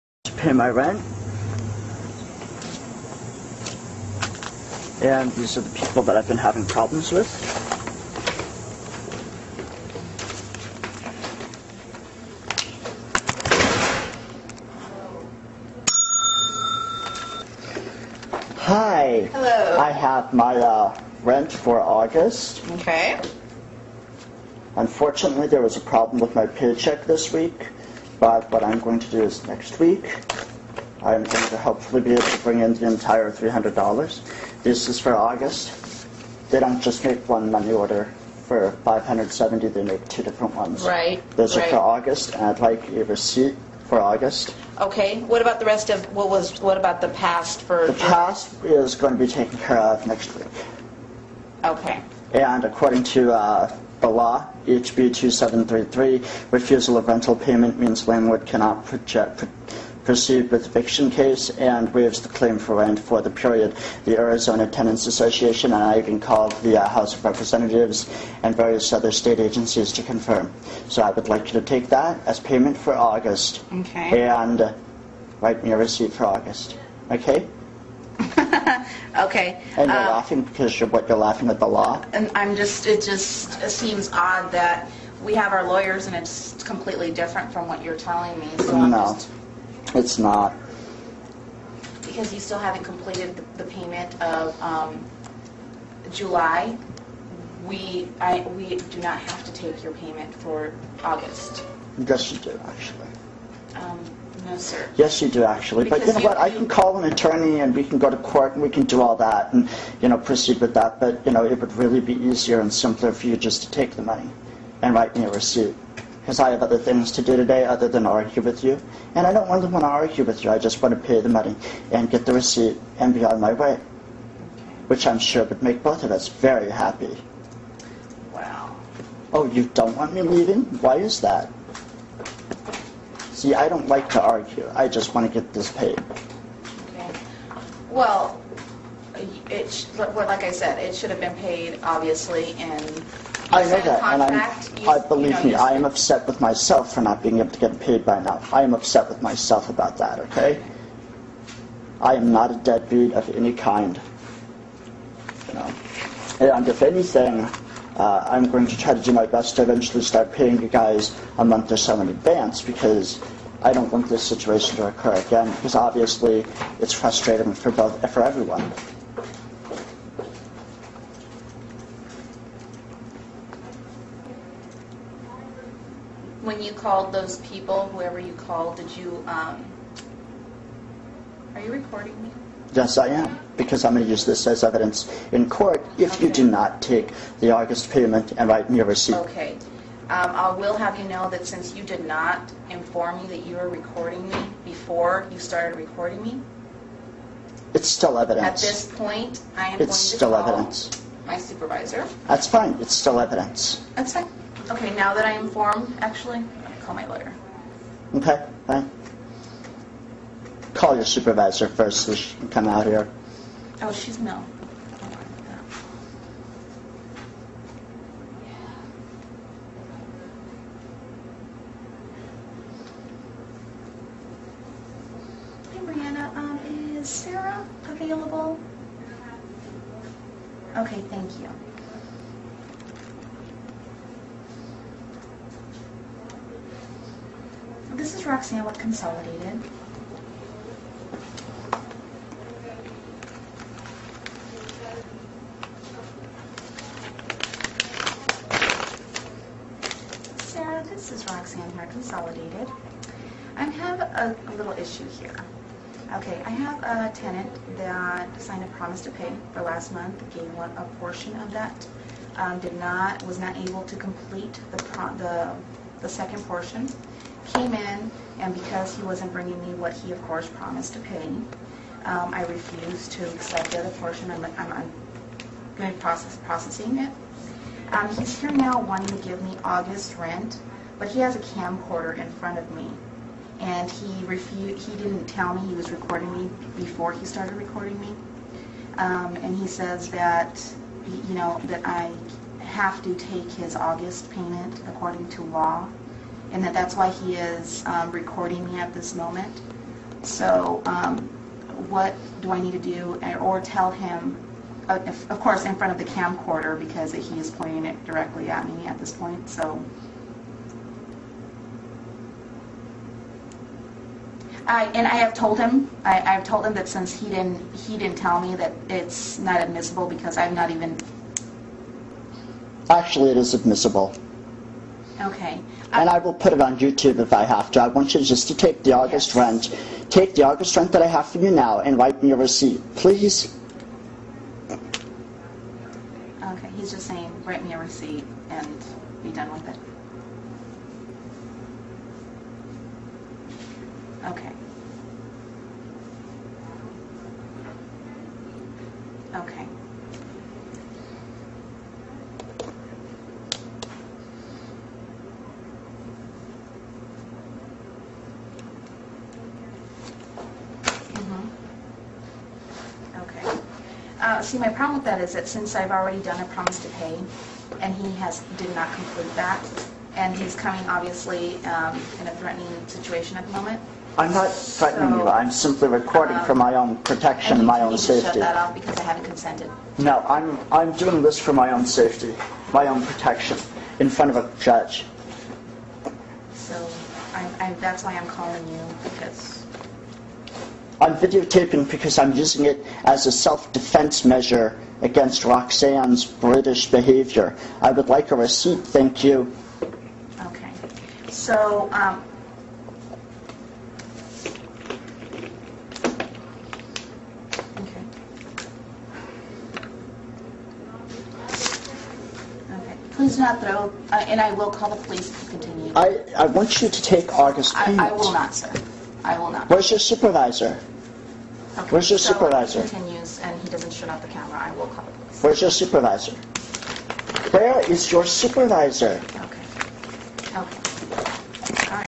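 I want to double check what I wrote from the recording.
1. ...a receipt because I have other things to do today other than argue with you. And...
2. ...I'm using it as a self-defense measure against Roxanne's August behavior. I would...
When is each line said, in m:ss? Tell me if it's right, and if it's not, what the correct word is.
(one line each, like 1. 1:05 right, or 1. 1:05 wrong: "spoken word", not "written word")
1. 1:55 right
2. 6:32 wrong: "British", not "August".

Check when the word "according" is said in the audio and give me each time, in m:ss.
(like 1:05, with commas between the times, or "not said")
0:52, 4:54.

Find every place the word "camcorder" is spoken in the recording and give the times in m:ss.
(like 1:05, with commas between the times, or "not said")
4:41, 5:06.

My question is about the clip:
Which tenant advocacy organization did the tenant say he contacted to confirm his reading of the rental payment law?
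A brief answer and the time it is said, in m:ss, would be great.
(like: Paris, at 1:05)
Arizona Tenants Association, at 1:04.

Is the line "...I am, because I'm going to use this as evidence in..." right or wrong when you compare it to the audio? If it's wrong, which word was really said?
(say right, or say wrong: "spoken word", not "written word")
right.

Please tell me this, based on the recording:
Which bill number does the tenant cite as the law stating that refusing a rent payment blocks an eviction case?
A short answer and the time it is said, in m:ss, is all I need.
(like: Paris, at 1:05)
HB 2733, at 0:54.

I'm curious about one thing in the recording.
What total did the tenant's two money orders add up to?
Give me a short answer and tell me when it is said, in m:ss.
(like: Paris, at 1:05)
570, at 0:38.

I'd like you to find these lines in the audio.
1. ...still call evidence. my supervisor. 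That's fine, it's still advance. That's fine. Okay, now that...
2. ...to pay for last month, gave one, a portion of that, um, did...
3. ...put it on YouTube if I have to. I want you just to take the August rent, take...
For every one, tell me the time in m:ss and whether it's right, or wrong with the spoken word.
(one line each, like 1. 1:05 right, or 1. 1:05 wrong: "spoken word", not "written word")
1. 3:20 wrong: "evidence", not "advance"
2. 4:19 right
3. 5:26 right.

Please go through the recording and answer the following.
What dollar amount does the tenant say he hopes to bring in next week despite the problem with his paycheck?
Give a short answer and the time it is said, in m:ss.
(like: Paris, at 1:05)
$300, at 0:33.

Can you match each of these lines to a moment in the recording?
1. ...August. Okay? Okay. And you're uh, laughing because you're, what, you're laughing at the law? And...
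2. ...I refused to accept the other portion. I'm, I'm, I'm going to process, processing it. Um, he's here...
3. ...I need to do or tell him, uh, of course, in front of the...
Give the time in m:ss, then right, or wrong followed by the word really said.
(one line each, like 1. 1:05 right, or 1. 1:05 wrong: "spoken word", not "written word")
1. 1:16 right
2. 4:32 right
3. 5:02 right.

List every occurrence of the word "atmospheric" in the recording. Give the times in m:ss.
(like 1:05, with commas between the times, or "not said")
not said.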